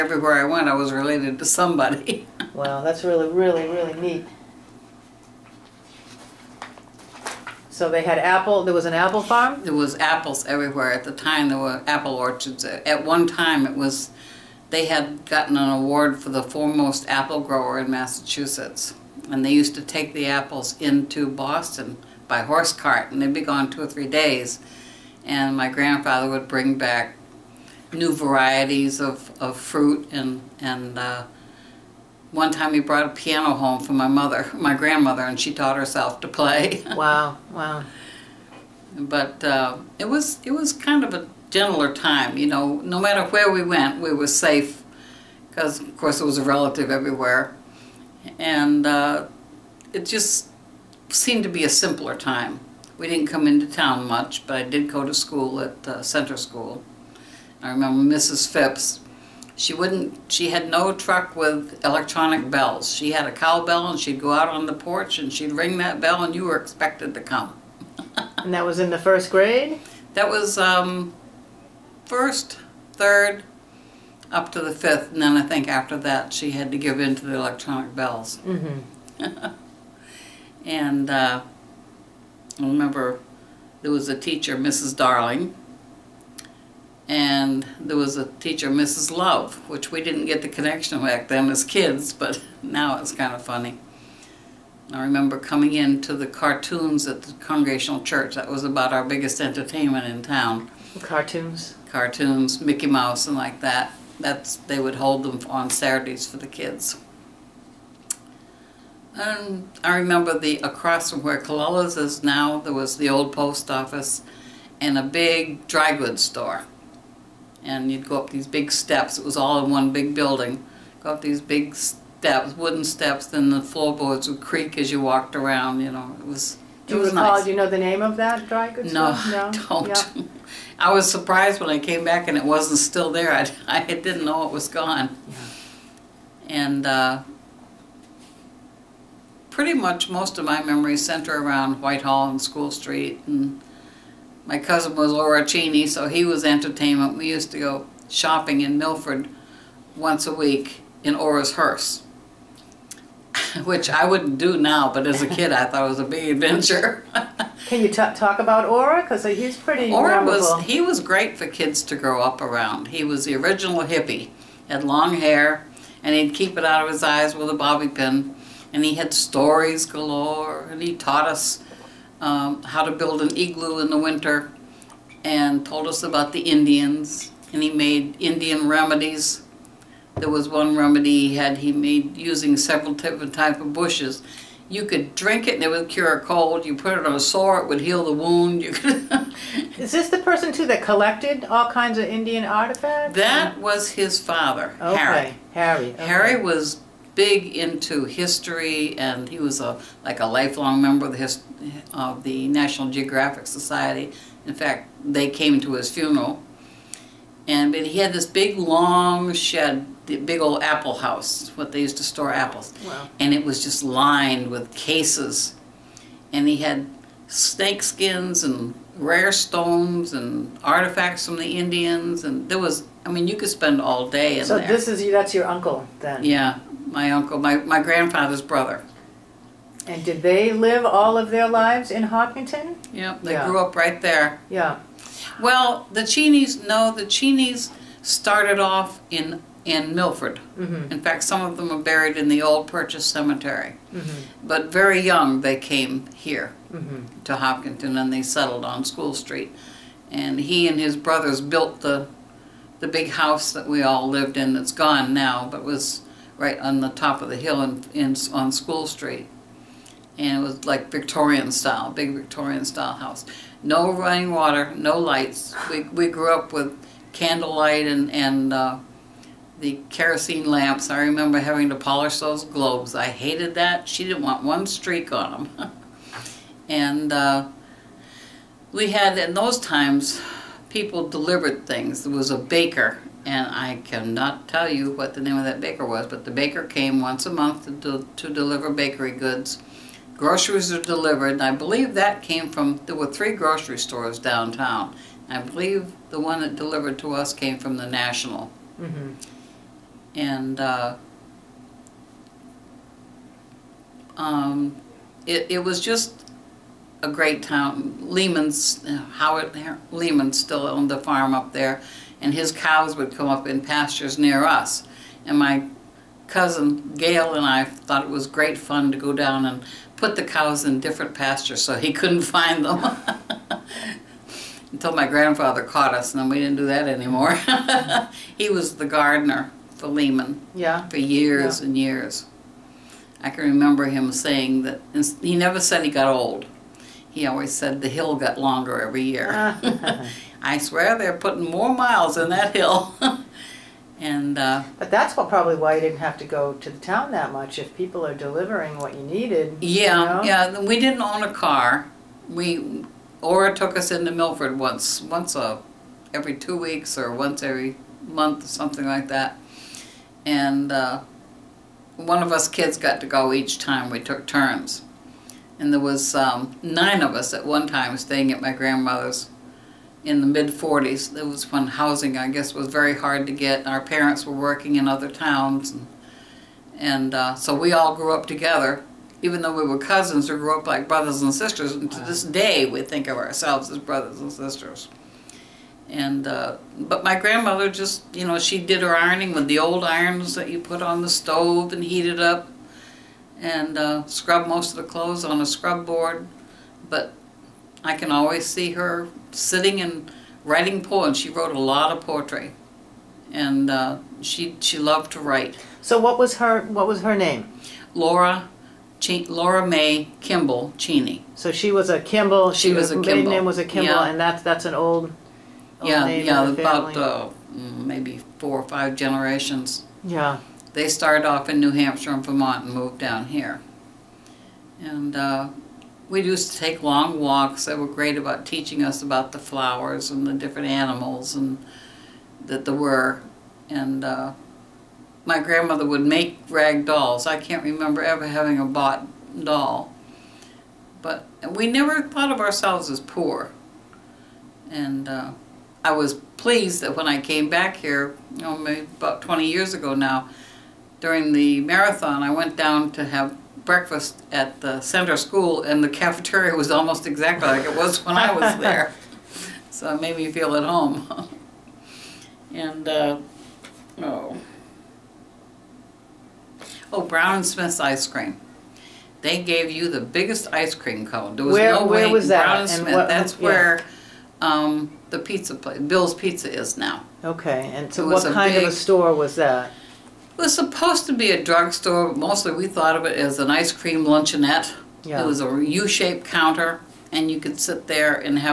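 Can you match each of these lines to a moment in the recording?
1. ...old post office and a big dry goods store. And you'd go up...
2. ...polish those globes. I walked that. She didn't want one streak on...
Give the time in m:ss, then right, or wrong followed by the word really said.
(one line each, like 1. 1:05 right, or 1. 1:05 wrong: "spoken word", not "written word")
1. 1:53 right
2. 4:31 wrong: "hated", not "walked".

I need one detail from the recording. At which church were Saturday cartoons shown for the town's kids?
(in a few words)
Congregational Church.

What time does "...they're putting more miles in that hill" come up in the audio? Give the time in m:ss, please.
5:40.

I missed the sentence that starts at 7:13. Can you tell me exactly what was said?
And uh, my grandmother would make rag dolls.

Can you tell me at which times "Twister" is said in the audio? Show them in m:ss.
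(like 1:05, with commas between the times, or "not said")
not said.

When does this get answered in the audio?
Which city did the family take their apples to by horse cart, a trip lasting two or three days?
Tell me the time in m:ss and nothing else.
0:21.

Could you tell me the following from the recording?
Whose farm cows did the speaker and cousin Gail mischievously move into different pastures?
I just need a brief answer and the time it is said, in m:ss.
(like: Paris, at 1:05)
Howard Lehman, at 5:09.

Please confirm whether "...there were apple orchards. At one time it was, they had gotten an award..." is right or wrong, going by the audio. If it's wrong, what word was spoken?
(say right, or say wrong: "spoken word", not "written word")
right.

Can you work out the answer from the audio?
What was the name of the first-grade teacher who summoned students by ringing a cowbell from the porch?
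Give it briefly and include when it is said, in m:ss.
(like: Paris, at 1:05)
Mrs. Phipps, at 0:58.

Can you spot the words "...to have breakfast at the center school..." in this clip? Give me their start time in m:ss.
7:32.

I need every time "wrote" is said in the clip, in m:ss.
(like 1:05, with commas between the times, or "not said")
6:41.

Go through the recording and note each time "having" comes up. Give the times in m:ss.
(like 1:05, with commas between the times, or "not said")
4:31, 7:18.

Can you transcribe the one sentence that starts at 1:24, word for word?
Darling, and there was a teacher, Mrs.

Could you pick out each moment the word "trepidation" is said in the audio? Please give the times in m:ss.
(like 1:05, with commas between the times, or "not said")
not said.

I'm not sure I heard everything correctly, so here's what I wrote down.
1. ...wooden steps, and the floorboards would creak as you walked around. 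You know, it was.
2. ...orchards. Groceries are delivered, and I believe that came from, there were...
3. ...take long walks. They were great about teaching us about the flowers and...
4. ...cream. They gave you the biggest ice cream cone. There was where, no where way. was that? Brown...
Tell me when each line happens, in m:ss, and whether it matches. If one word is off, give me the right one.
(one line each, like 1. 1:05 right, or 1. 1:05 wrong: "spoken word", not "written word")
1. 2:02 right
2. 4:49 wrong: "goods", not "orchards"
3. 7:06 right
4. 7:48 right.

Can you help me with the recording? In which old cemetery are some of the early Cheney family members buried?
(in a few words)
Purchase Cemetery.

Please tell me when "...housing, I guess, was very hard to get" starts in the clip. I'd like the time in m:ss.
6:11.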